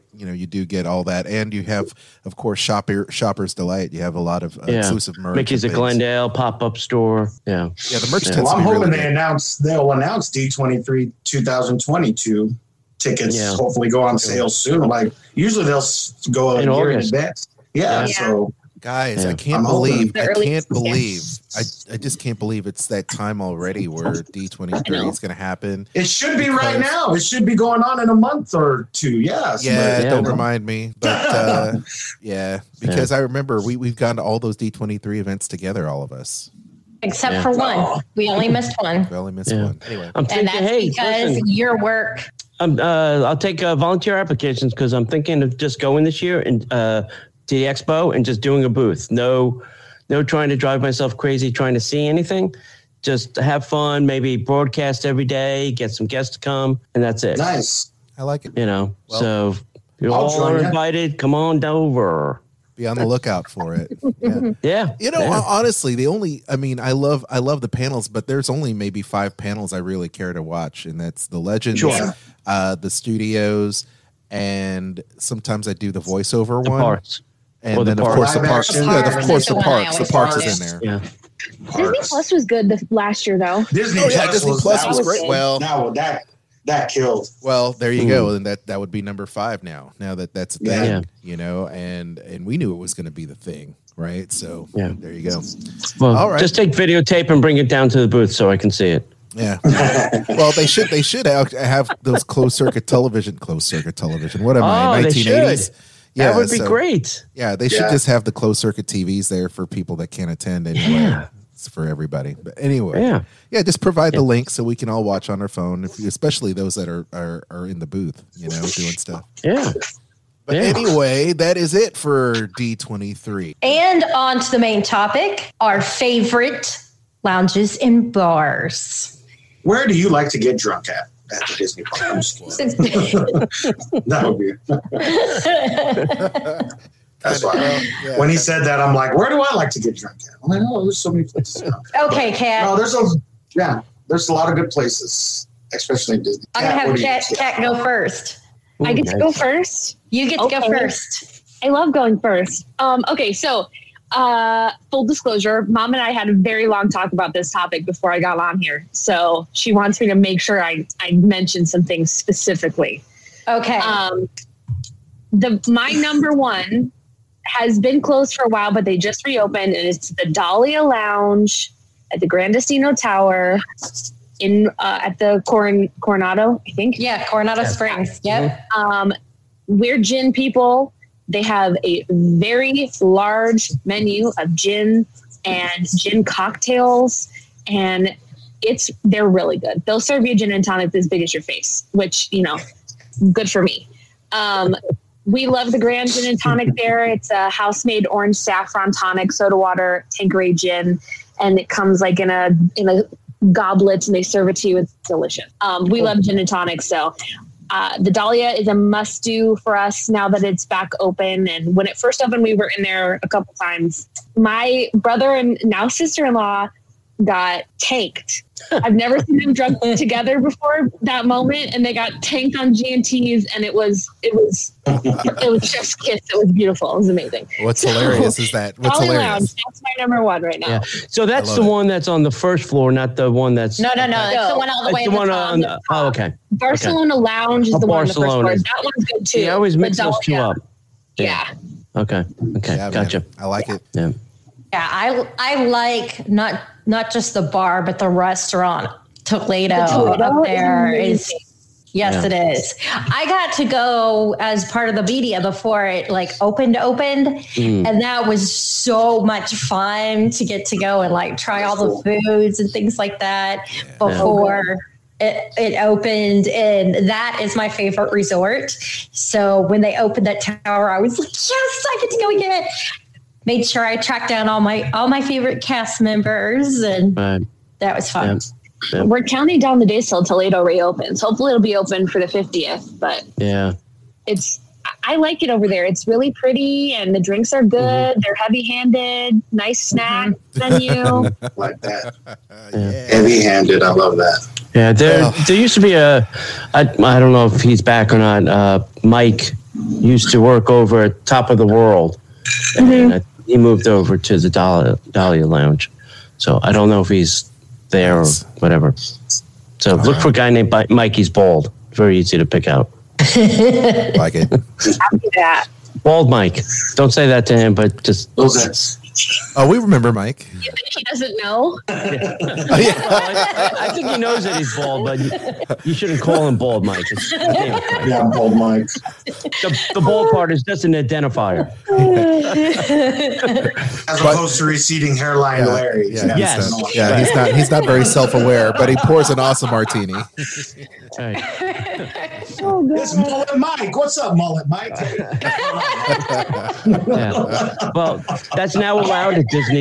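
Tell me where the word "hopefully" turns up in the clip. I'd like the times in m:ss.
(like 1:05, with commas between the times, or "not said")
0:13, 4:41.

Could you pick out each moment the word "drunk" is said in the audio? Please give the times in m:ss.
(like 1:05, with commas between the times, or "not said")
2:10, 2:19, 3:39.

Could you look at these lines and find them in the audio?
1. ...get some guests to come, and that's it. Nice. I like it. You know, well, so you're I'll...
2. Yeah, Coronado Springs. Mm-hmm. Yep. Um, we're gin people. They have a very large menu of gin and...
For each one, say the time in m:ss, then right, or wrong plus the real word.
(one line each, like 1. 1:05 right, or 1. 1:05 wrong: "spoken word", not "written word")
1. 0:55 right
2. 2:56 right.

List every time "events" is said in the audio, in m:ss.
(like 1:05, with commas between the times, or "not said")
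0:35.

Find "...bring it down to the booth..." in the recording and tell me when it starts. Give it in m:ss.
1:37.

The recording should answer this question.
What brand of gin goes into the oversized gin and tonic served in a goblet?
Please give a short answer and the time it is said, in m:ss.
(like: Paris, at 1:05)
Tanqueray, at 3:20.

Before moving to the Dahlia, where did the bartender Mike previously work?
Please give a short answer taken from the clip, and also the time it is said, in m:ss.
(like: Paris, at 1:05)
Top of the World, at 5:01.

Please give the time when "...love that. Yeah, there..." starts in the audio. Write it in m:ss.
4:53.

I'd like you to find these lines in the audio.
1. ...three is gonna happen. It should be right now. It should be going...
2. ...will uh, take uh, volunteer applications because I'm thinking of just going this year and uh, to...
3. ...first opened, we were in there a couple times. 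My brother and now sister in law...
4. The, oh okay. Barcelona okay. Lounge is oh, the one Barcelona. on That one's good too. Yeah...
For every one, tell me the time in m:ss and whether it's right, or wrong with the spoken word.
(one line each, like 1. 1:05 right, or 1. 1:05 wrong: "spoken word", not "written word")
1. 0:24 right
2. 0:42 right
3. 3:31 right
4. 3:55 right.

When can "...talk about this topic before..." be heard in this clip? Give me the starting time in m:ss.
2:36.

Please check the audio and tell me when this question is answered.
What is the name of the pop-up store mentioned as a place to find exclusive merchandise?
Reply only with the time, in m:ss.
0:05.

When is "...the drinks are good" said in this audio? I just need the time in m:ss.
4:47.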